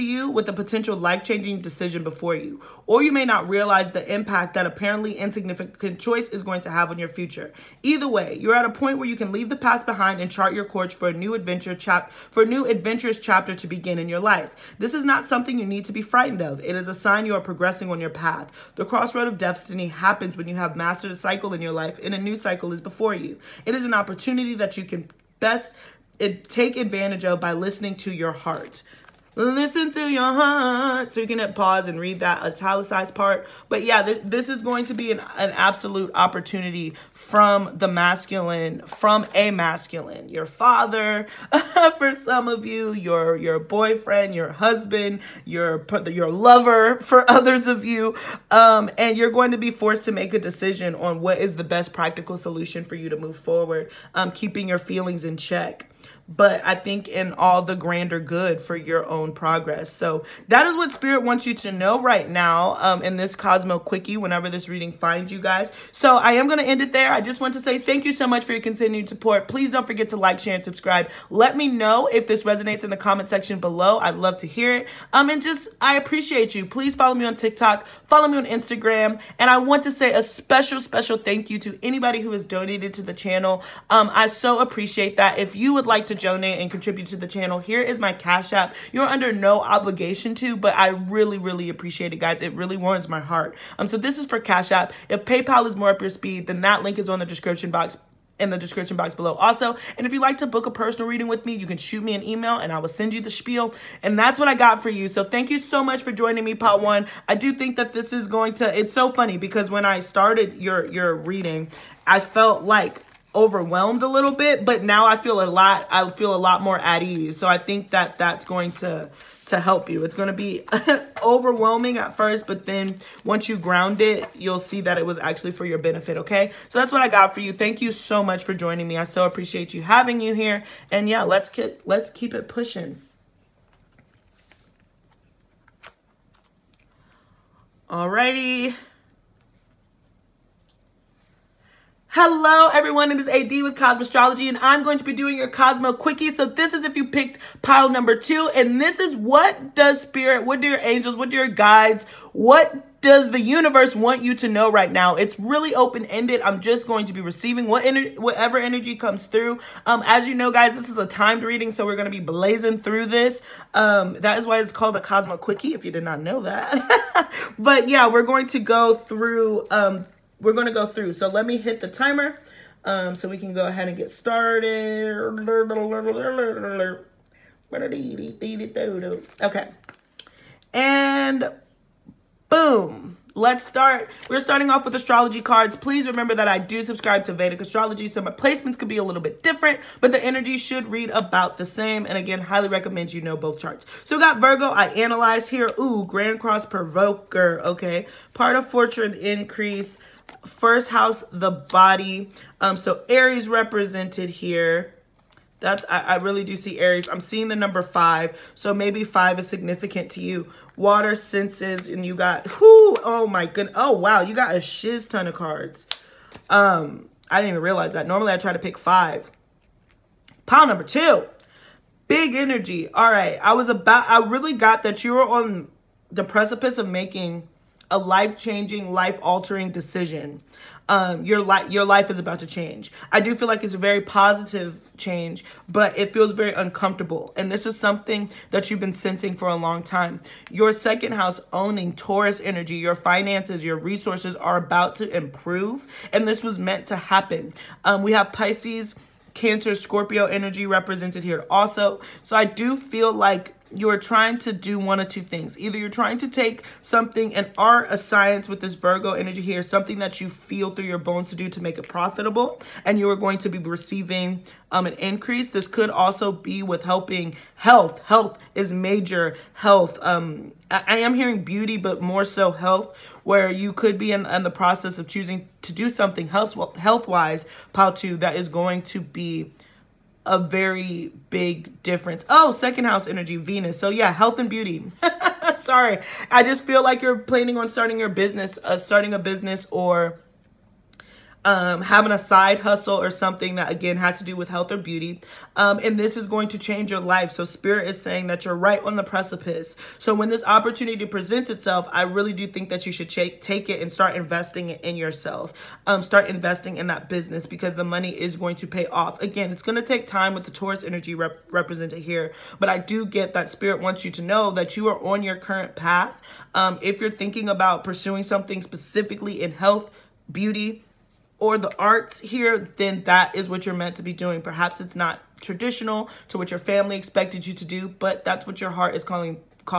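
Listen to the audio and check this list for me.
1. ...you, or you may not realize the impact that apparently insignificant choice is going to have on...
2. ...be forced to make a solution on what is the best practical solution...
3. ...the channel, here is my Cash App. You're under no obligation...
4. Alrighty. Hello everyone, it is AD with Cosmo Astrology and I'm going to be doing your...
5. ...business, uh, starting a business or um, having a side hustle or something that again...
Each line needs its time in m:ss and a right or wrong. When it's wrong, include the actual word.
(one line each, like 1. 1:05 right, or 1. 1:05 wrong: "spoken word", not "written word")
1. 0:02 right
2. 0:49 wrong: "decision", not "solution"
3. 1:27 right
4. 2:17 right
5. 4:48 right.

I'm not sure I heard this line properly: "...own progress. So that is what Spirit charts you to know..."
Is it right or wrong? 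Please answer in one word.
wrong.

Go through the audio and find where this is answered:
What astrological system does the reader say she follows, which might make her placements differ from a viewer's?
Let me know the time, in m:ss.
3:07.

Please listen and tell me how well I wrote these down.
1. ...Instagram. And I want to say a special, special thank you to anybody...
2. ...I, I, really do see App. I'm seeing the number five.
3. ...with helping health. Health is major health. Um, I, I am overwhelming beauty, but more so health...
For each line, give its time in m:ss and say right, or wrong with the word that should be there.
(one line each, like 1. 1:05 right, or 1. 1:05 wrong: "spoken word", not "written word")
1. 1:18 right
2. 3:25 wrong: "Aries", not "App"
3. 4:26 wrong: "hearing", not "overwhelming".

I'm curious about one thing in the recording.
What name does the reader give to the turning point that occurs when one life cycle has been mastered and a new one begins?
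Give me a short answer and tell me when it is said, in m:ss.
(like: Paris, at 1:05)
Crossroad of Destiny, at 0:18.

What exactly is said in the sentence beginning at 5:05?
Um, start investing in that business because the money is going to pay off.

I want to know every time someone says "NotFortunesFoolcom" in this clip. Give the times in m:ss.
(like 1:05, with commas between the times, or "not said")
not said.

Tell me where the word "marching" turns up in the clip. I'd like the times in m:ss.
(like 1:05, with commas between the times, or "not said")
not said.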